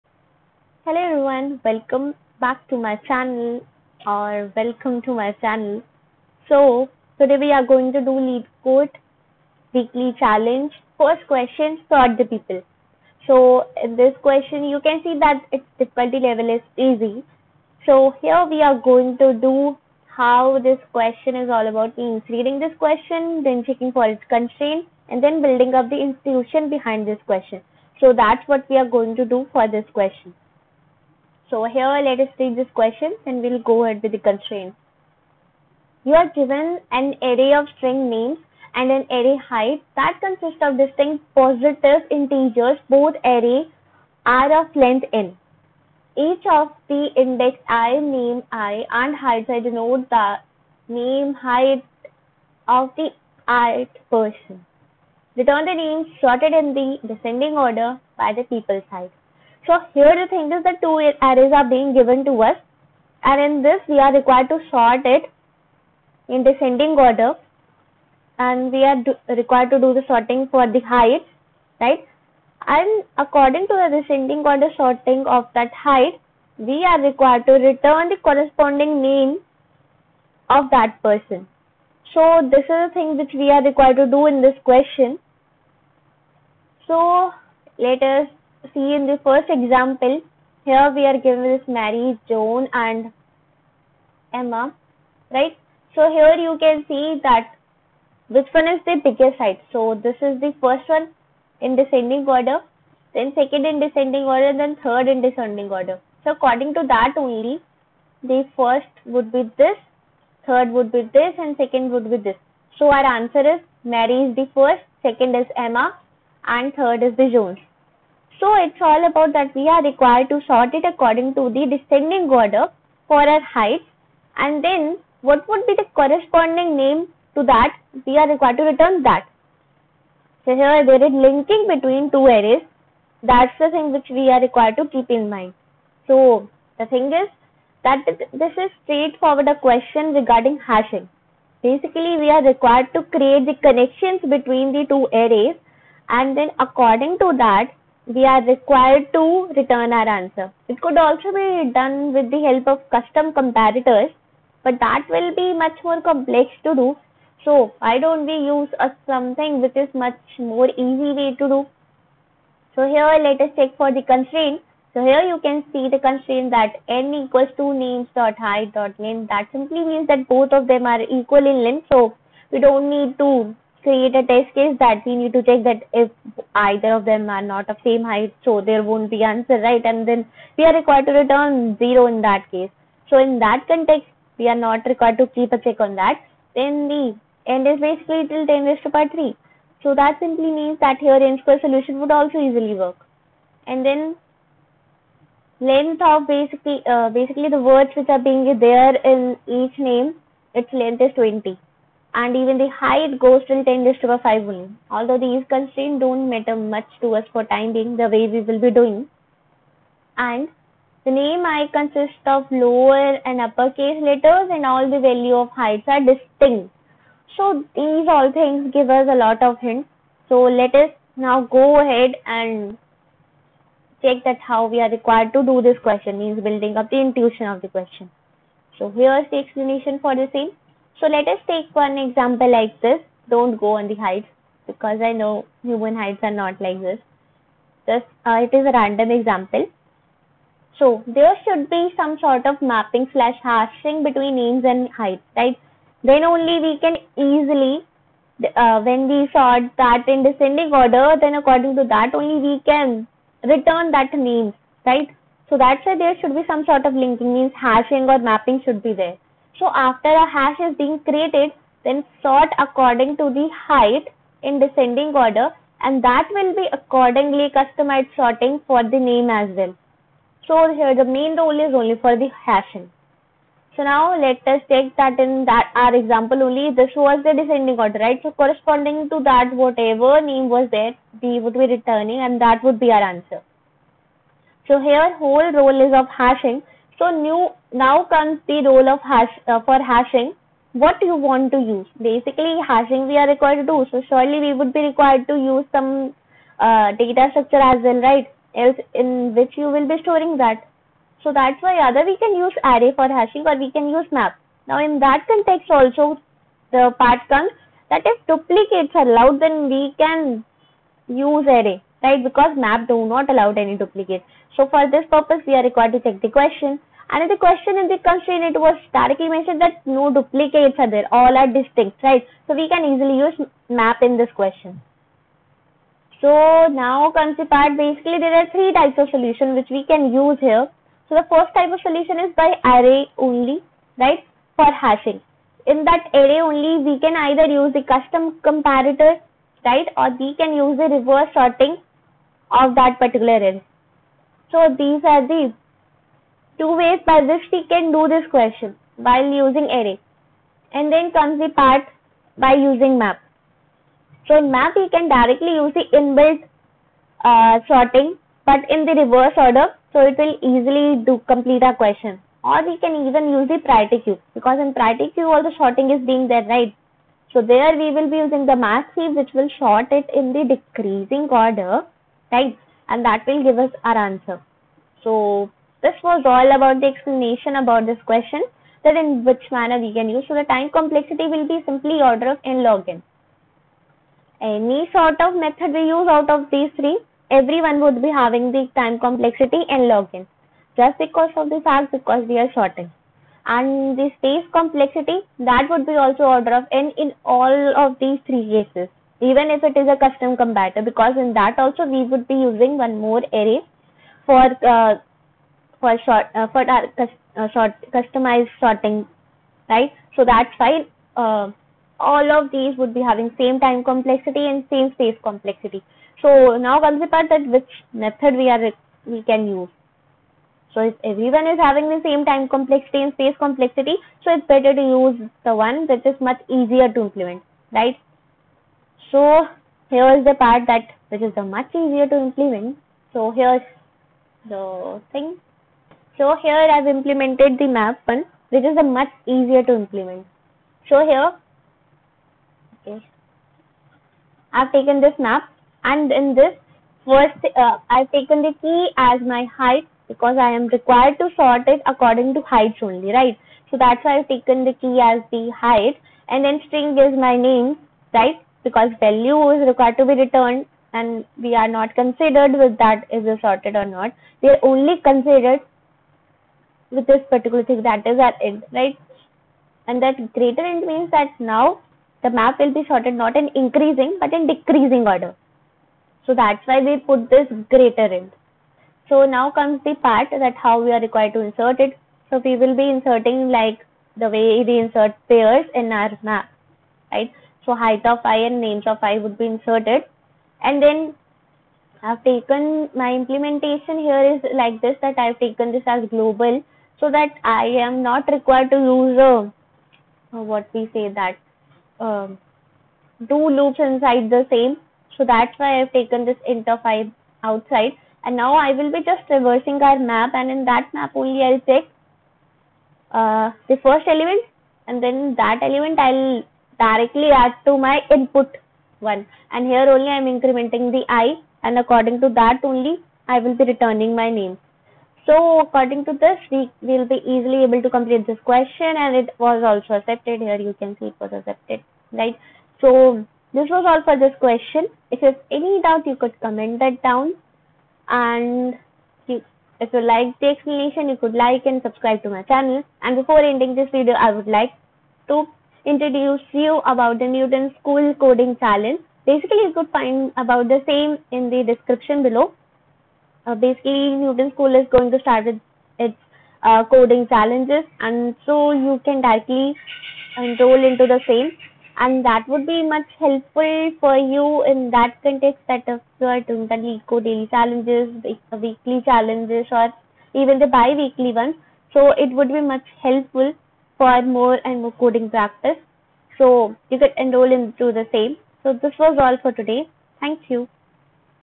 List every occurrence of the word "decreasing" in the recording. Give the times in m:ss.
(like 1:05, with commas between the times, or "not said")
6:10, 7:54.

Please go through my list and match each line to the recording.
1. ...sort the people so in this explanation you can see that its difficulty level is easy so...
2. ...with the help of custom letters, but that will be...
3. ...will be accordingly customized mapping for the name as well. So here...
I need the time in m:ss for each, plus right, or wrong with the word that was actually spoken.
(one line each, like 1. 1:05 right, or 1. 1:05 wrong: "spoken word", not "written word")
1. 0:11 wrong: "question", not "explanation"
2. 2:32 wrong: "comparators", not "letters"
3. 4:26 wrong: "sorting", not "mapping".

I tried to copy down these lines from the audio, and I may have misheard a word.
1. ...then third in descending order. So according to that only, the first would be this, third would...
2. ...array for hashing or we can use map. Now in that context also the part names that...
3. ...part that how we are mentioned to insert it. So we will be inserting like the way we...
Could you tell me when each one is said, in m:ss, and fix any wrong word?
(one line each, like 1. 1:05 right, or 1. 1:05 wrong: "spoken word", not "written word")
1. 1:44 right
2. 5:02 wrong: "comes", not "names"
3. 7:59 wrong: "required", not "mentioned".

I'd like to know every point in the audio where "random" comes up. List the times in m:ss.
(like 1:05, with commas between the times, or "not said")
3:58.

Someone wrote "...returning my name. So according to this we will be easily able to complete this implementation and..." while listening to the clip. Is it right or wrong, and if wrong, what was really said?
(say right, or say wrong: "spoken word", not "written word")
wrong: "question", not "implementation".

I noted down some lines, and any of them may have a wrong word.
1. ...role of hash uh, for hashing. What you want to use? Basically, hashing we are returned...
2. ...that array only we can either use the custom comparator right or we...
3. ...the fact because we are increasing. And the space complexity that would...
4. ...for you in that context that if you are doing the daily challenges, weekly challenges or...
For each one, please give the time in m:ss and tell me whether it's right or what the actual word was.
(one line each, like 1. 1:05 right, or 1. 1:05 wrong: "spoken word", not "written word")
1. 4:48 wrong: "required", not "returned"
2. 5:35 right
3. 6:31 wrong: "sorting", not "increasing"
4. 9:23 right.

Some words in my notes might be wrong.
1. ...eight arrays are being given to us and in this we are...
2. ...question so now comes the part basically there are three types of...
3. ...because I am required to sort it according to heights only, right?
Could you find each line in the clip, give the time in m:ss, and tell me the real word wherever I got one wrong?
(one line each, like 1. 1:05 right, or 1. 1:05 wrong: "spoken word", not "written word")
1. 1:00 wrong: "two", not "eight"
2. 5:24 right
3. 7:30 right.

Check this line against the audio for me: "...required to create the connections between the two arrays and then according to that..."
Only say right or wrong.
right.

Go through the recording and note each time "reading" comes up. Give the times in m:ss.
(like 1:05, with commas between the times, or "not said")
0:22.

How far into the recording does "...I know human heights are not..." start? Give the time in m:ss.
3:55.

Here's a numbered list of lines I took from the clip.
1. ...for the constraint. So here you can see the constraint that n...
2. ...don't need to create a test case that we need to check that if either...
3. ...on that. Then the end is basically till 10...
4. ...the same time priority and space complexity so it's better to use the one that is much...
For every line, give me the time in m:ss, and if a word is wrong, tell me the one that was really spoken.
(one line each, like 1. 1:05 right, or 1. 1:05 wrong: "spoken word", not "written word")
1. 2:43 right
2. 2:52 right
3. 3:05 right
4. 7:01 wrong: "complexity", not "priority".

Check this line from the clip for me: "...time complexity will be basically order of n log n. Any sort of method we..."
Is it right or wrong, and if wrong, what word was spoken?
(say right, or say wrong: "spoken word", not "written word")
wrong: "simply", not "basically".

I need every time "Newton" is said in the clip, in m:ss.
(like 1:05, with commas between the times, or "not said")
9:07, 9:14.